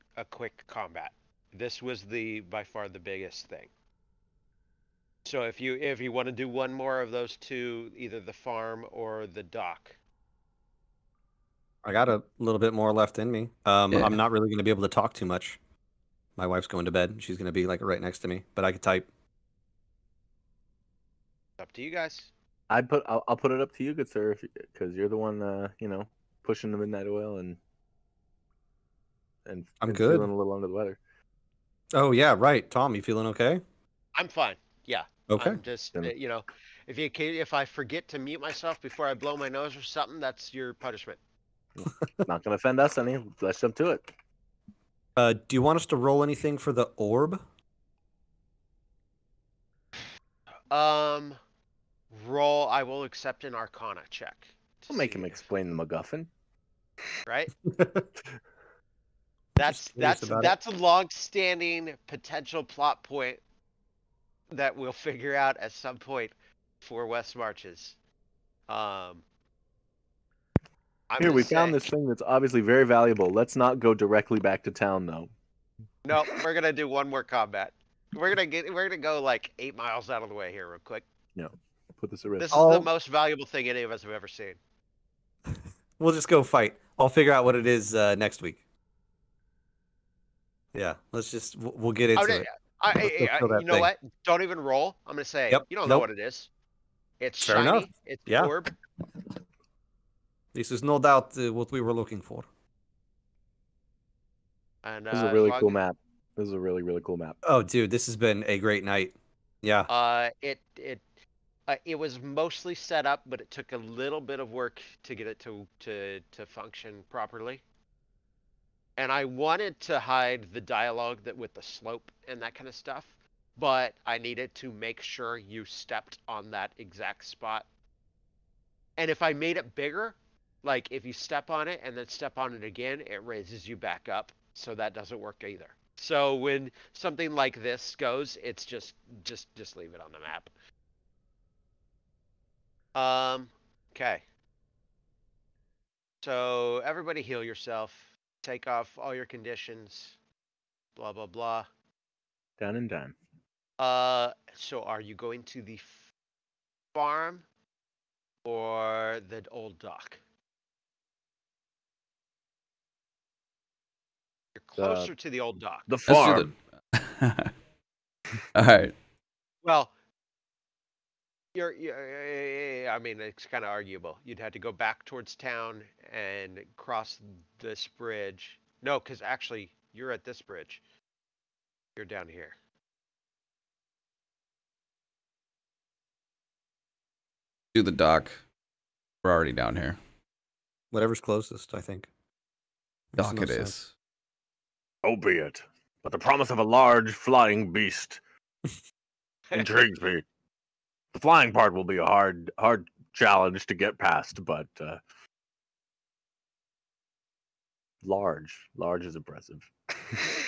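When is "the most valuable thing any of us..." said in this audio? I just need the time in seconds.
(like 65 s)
82 s.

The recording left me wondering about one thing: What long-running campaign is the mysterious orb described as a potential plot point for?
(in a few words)
West Marches.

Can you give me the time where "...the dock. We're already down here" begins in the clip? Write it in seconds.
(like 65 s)
187 s.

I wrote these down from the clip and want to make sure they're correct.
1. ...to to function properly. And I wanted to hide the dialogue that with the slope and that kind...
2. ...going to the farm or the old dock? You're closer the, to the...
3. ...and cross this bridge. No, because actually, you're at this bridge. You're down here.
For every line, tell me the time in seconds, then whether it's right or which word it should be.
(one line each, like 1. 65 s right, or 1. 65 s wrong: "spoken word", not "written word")
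1. 115 s right
2. 155 s right
3. 176 s right.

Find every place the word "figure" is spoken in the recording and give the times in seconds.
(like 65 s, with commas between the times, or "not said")
64 s, 87 s.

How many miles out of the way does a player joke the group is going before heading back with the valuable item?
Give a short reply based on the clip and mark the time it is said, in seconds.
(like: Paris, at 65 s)
8, at 79 s.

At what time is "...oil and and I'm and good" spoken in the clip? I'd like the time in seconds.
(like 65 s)
27 s.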